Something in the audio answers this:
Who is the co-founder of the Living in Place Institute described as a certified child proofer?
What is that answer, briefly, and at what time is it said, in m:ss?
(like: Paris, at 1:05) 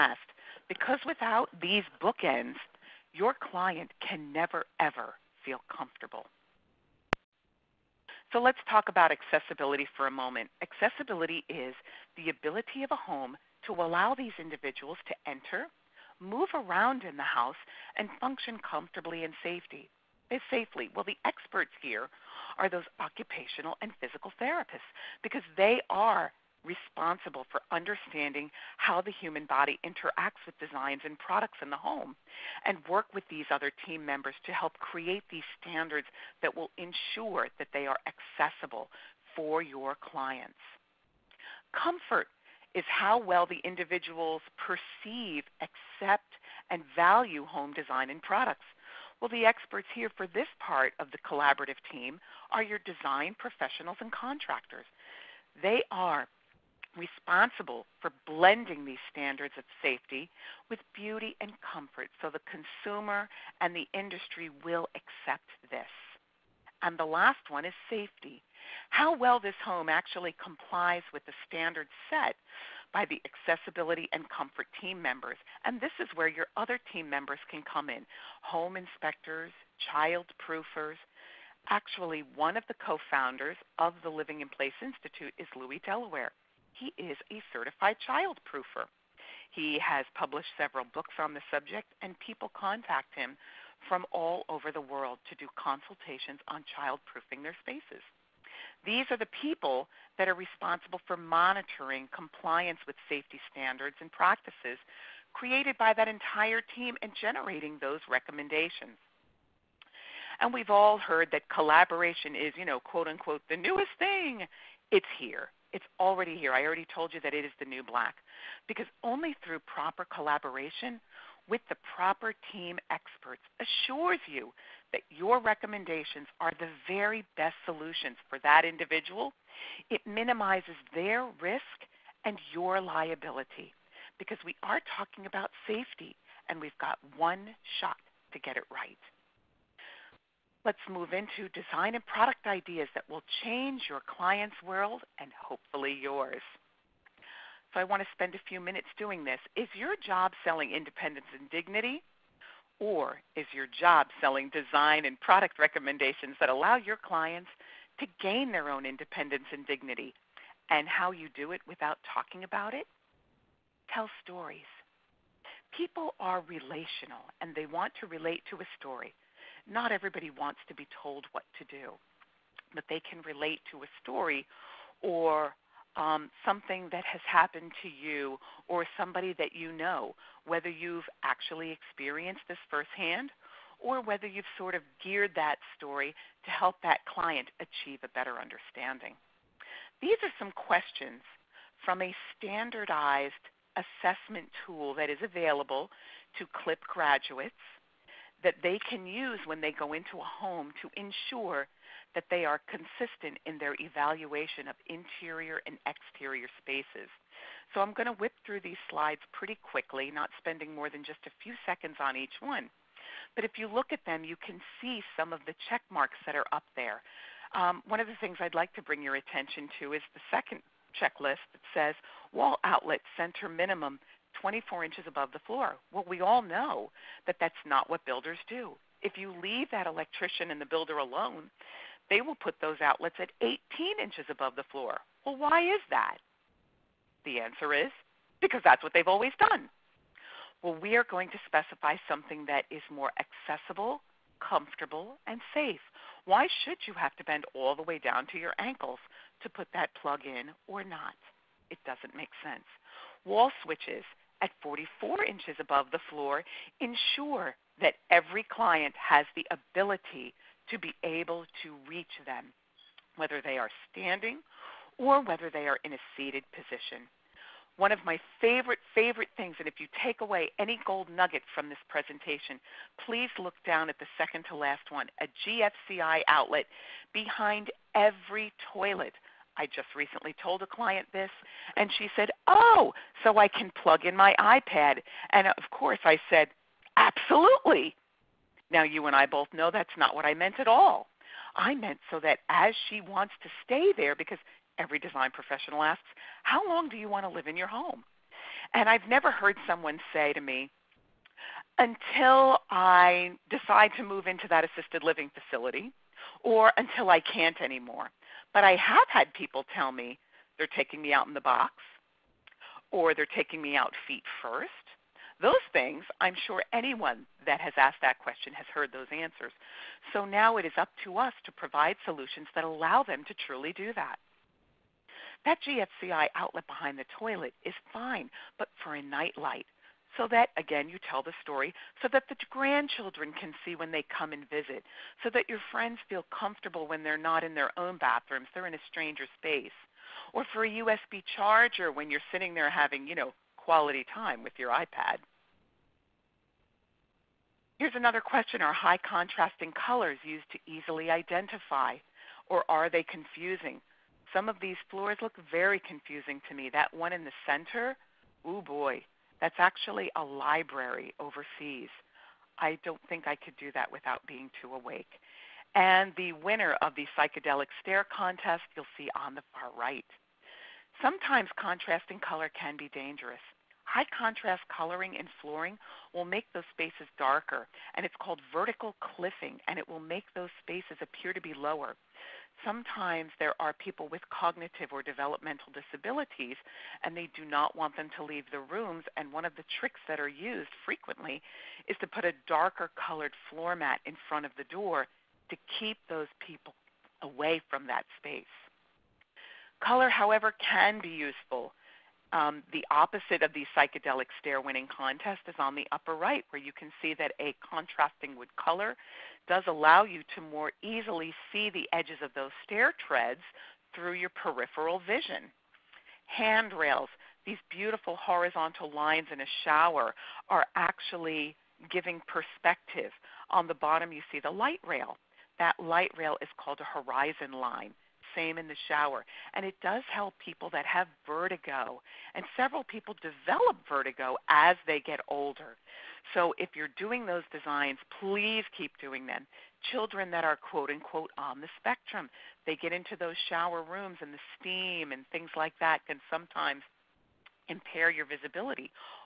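Louis Delaware, at 1:25.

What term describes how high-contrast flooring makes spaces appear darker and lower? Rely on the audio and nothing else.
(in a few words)
Vertical cliffing.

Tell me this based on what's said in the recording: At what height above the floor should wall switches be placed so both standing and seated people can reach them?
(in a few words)
44 inches.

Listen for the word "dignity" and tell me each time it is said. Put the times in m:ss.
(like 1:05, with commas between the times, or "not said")
2:31, 2:39.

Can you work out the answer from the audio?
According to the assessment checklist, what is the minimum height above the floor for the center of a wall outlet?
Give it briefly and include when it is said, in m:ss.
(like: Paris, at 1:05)
24 inches, at 3:44.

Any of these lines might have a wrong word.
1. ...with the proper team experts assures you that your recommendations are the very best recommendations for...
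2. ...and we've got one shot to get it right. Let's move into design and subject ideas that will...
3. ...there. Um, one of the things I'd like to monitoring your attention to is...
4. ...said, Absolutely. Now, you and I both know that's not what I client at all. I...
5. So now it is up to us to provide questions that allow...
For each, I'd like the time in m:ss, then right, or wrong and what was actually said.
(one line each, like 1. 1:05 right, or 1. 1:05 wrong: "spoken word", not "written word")
1. 2:01 wrong: "solutions", not "recommendations"
2. 2:16 wrong: "product", not "subject"
3. 3:36 wrong: "bring", not "monitoring"
4. 4:46 wrong: "meant", not "client"
5. 5:20 wrong: "solutions", not "questions".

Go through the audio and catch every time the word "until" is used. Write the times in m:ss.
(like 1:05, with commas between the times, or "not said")
5:01, 5:06.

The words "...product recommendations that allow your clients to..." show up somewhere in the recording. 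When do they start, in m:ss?
2:35.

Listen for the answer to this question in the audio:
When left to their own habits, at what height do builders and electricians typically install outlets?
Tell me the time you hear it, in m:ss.
3:53.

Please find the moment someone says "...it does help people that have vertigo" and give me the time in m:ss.
7:09.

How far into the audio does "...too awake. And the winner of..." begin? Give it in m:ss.
6:04.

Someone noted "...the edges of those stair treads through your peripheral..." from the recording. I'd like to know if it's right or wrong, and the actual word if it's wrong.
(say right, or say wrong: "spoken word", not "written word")
right.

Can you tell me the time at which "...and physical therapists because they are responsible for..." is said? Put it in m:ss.
0:23.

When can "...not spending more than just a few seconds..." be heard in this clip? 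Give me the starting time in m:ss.
3:30.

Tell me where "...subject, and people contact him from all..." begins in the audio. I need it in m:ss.
1:31.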